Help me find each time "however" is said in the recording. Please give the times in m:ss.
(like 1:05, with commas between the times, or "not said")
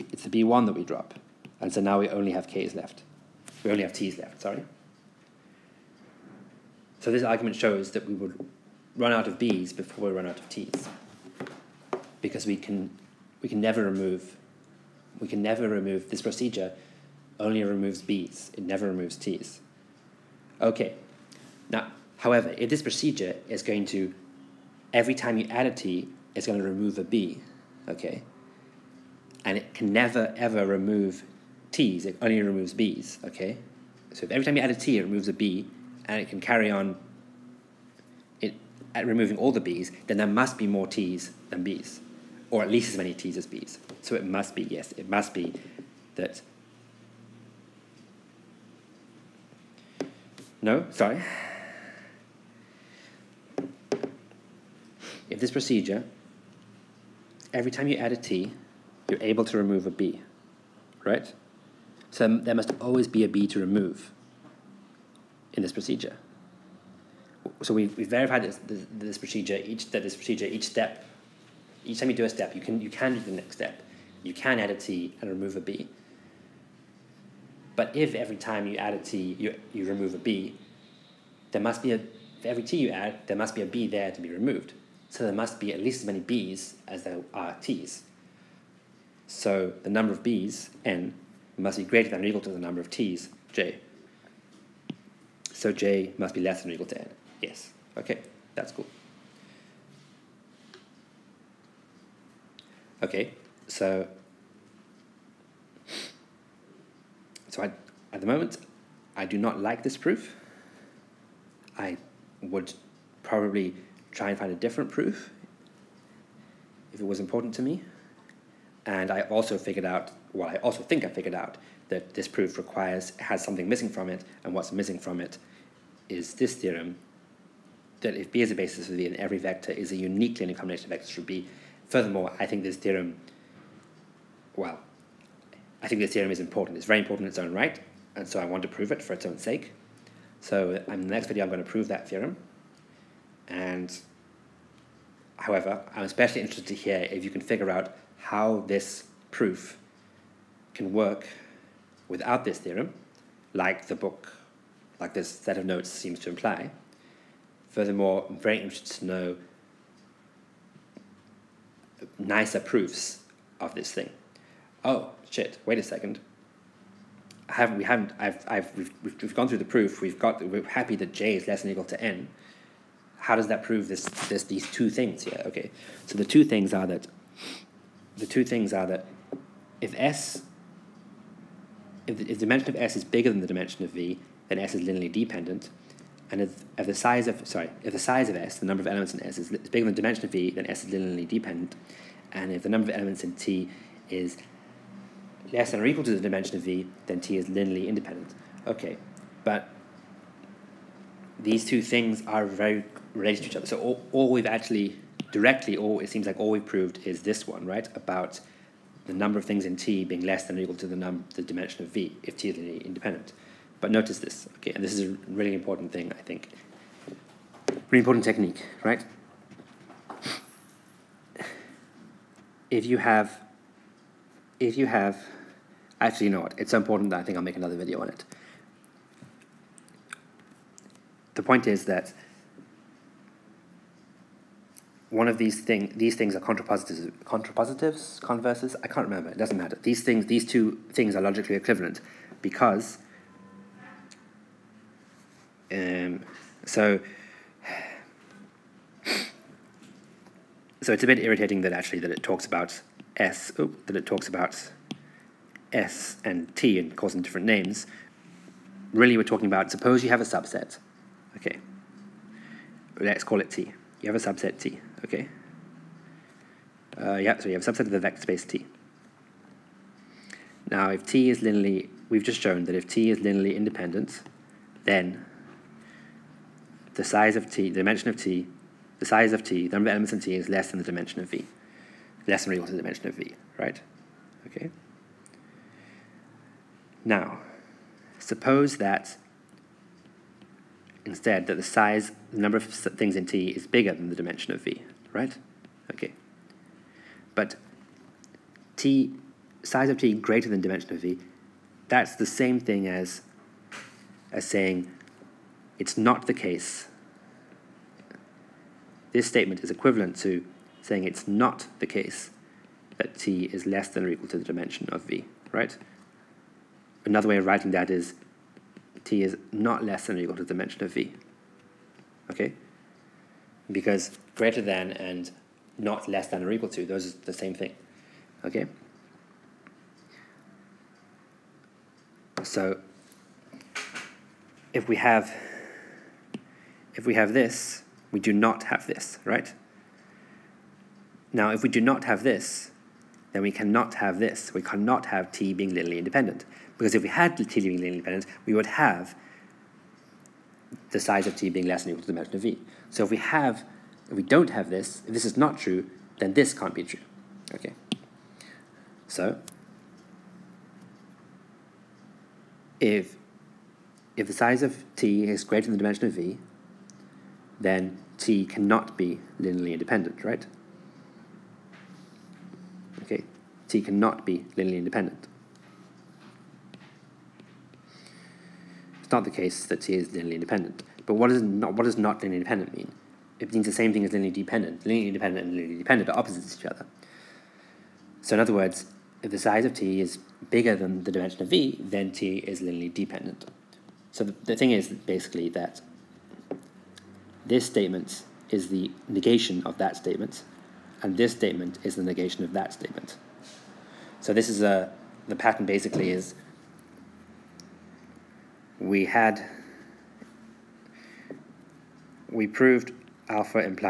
0:22, 2:25.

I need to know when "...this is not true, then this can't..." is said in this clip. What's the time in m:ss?
5:55.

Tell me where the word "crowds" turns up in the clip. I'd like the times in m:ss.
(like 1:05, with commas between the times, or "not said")
not said.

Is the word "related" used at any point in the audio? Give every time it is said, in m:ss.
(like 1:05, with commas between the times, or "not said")
3:23.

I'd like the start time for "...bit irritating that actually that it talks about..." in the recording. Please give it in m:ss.
4:11.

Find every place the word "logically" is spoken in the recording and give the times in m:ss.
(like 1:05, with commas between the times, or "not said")
4:01.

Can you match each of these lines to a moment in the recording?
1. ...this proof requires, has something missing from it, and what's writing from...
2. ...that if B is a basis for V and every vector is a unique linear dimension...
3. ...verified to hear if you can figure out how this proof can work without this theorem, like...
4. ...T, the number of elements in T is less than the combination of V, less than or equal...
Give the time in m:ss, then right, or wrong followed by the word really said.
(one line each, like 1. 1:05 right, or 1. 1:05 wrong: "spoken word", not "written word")
1. 2:02 wrong: "missing", not "writing"
2. 2:08 wrong: "combination", not "dimension"
3. 2:26 wrong: "interested", not "verified"
4. 4:39 wrong: "dimension", not "combination".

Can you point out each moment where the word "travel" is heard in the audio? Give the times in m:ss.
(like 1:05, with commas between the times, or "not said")
not said.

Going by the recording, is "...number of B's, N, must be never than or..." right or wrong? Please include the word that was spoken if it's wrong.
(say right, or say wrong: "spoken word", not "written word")
wrong: "greater", not "never".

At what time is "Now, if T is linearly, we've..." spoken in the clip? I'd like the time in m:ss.
4:30.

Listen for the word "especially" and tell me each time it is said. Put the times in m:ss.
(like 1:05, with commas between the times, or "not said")
2:26.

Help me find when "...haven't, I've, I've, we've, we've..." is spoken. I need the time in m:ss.
2:47.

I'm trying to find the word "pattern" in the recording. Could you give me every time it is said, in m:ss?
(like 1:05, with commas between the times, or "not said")
6:45.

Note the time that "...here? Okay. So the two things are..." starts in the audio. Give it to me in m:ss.
2:55.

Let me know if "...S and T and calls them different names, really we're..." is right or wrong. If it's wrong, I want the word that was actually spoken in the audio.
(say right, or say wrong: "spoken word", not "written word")
right.